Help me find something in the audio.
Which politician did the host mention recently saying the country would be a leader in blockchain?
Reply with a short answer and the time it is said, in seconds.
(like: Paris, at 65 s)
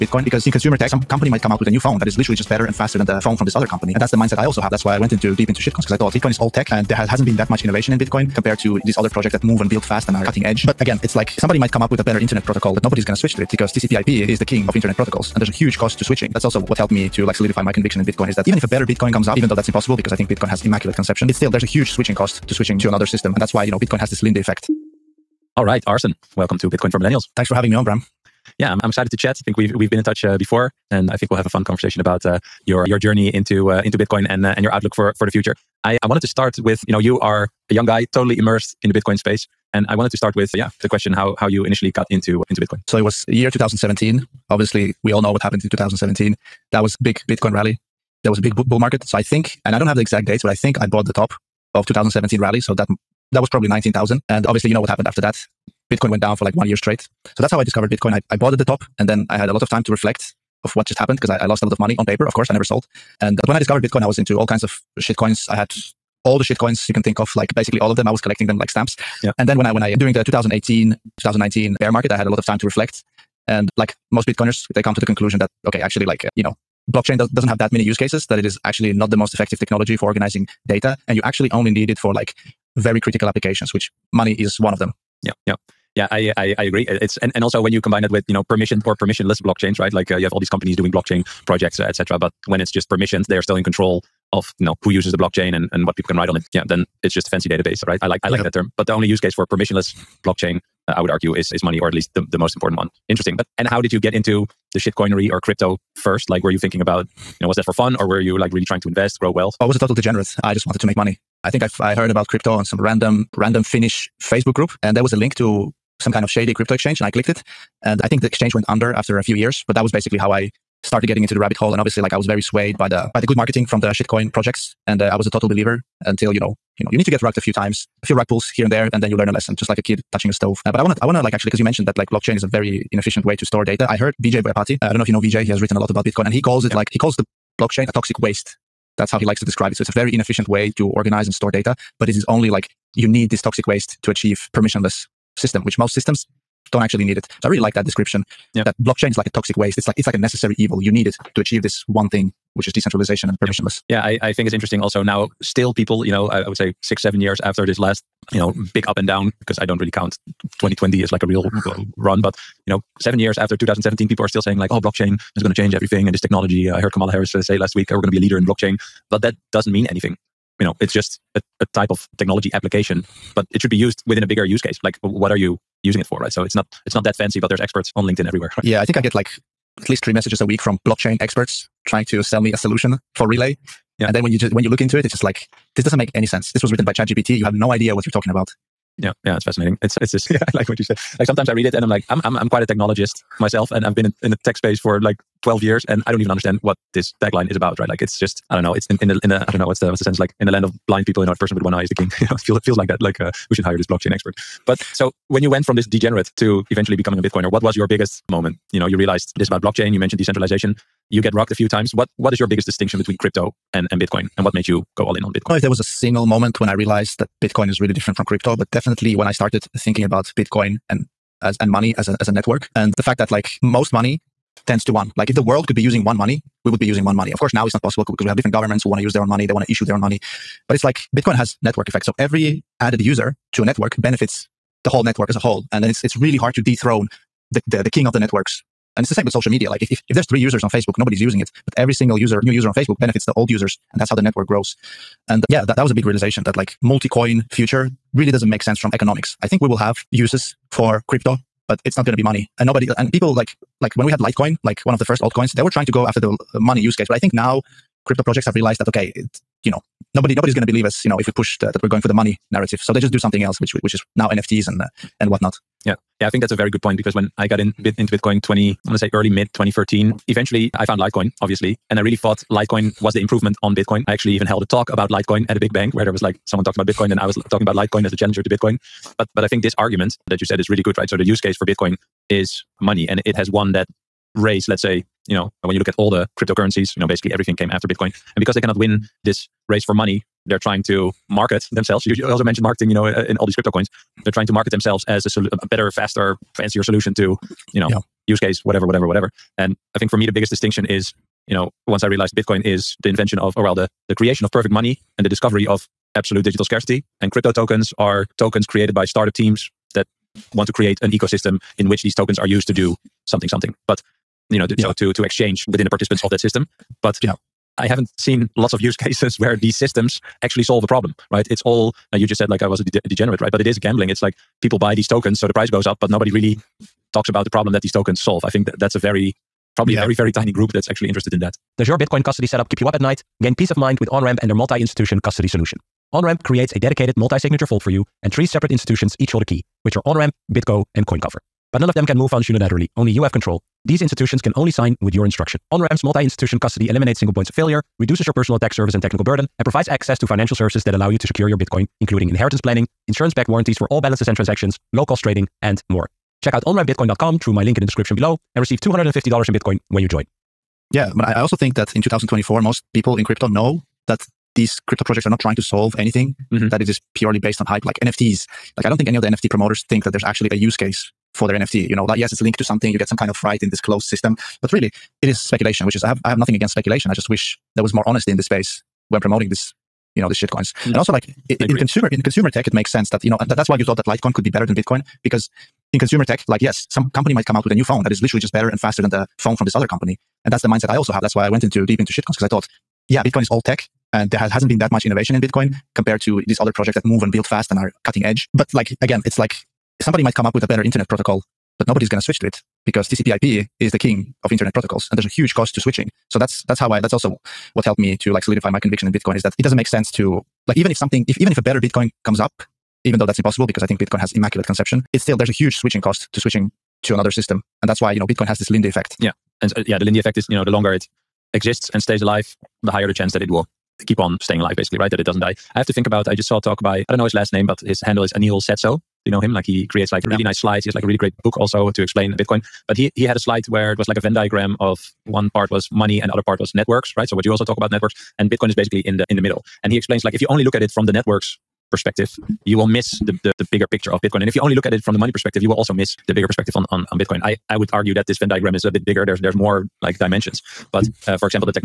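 Kamala Harris, at 166 s.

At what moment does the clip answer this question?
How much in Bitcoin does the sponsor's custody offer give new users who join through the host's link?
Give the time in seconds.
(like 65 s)
358 s.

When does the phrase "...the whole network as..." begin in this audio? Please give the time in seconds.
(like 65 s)
234 s.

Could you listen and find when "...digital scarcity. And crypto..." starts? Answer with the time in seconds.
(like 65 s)
306 s.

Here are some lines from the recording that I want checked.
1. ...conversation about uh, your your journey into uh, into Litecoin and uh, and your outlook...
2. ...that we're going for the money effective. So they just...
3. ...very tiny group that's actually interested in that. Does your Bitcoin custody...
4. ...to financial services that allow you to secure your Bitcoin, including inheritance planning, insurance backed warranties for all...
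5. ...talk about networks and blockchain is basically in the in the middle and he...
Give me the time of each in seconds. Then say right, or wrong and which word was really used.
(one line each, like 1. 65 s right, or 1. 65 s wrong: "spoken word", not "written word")
1. 31 s wrong: "Bitcoin", not "Litecoin"
2. 261 s wrong: "narrative", not "effective"
3. 330 s right
4. 350 s right
5. 437 s wrong: "bitcoin", not "blockchain".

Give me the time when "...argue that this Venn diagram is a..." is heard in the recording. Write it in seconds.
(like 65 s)
447 s.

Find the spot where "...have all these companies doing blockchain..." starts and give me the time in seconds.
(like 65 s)
90 s.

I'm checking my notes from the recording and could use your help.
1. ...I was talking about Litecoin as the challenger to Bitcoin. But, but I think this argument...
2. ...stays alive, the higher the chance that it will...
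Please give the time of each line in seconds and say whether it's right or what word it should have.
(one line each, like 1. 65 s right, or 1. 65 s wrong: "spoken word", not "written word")
1. 277 s right
2. 422 s right.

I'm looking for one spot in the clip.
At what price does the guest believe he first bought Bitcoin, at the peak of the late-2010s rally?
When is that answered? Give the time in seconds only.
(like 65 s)
53 s.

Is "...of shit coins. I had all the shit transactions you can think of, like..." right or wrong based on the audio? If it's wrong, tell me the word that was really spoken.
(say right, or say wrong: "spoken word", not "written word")
wrong: "coins", not "transactions".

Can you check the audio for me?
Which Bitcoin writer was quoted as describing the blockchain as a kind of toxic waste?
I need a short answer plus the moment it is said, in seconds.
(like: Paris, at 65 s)
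Vijay Boyapati, at 134 s.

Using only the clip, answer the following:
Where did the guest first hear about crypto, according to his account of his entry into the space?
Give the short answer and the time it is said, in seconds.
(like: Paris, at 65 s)
Finnish Facebook group, at 113 s.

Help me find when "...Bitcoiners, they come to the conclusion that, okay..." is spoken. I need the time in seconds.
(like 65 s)
74 s.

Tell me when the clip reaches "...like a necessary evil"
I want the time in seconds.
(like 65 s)
150 s.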